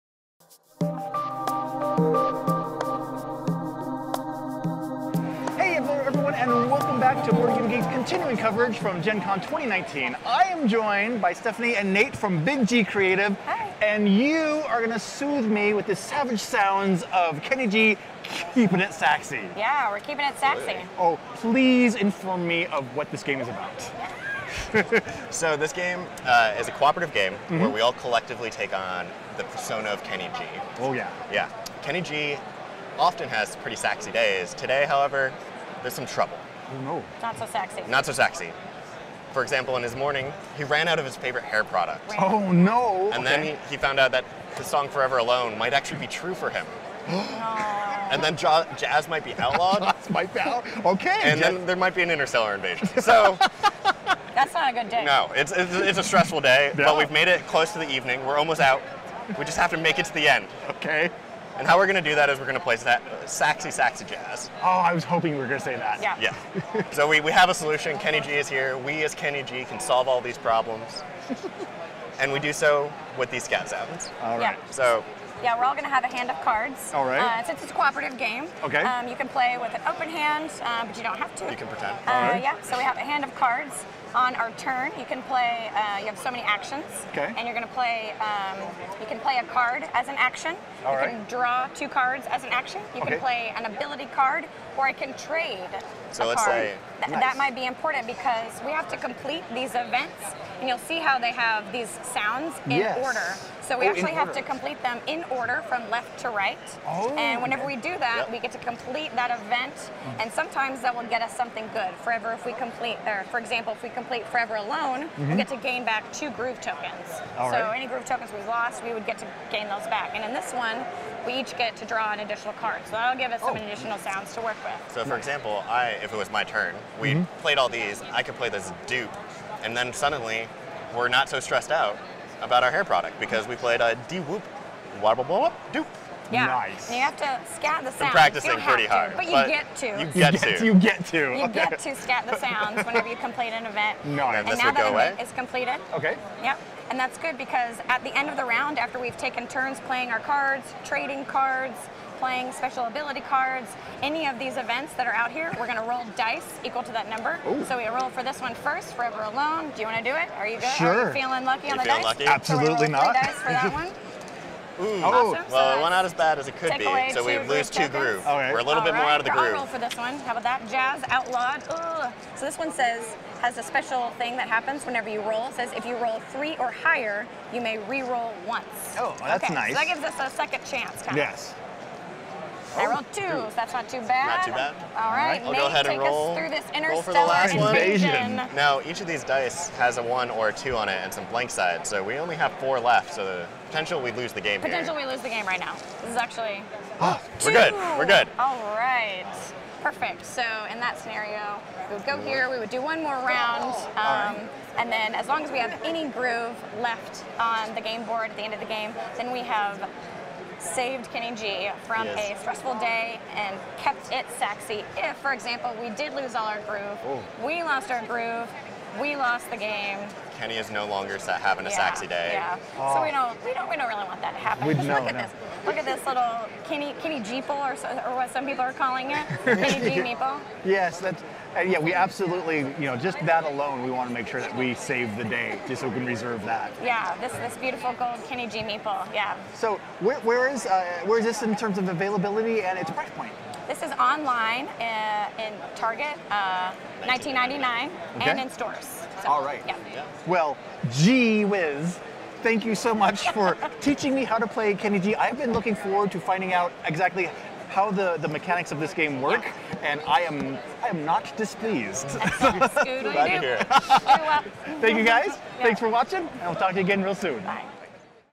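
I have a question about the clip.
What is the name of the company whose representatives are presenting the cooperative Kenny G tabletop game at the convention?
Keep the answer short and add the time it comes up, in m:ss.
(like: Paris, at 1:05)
Big G Creative, at 0:12.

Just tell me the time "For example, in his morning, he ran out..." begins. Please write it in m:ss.
0:39.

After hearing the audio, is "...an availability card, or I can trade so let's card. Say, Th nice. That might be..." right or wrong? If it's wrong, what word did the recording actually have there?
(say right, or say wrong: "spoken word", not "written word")
wrong: "ability", not "availability".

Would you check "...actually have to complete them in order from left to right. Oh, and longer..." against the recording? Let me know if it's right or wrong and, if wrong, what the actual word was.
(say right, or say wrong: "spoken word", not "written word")
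wrong: "whenever", not "longer".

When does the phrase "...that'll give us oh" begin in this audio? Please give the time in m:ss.
2:02.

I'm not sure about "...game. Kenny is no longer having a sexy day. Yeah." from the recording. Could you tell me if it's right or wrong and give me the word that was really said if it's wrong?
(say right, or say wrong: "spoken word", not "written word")
right.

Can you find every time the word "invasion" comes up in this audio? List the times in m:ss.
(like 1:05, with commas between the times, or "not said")
0:52, 3:07.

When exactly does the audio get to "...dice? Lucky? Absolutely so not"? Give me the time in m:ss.
2:41.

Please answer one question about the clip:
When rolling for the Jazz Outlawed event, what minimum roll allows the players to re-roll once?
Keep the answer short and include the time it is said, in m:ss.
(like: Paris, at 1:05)
3, at 2:56.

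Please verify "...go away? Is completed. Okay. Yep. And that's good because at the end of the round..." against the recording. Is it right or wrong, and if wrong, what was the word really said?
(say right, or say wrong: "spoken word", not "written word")
right.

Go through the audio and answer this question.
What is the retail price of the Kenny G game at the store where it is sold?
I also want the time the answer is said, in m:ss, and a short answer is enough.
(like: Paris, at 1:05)
$19.99, at 4:07.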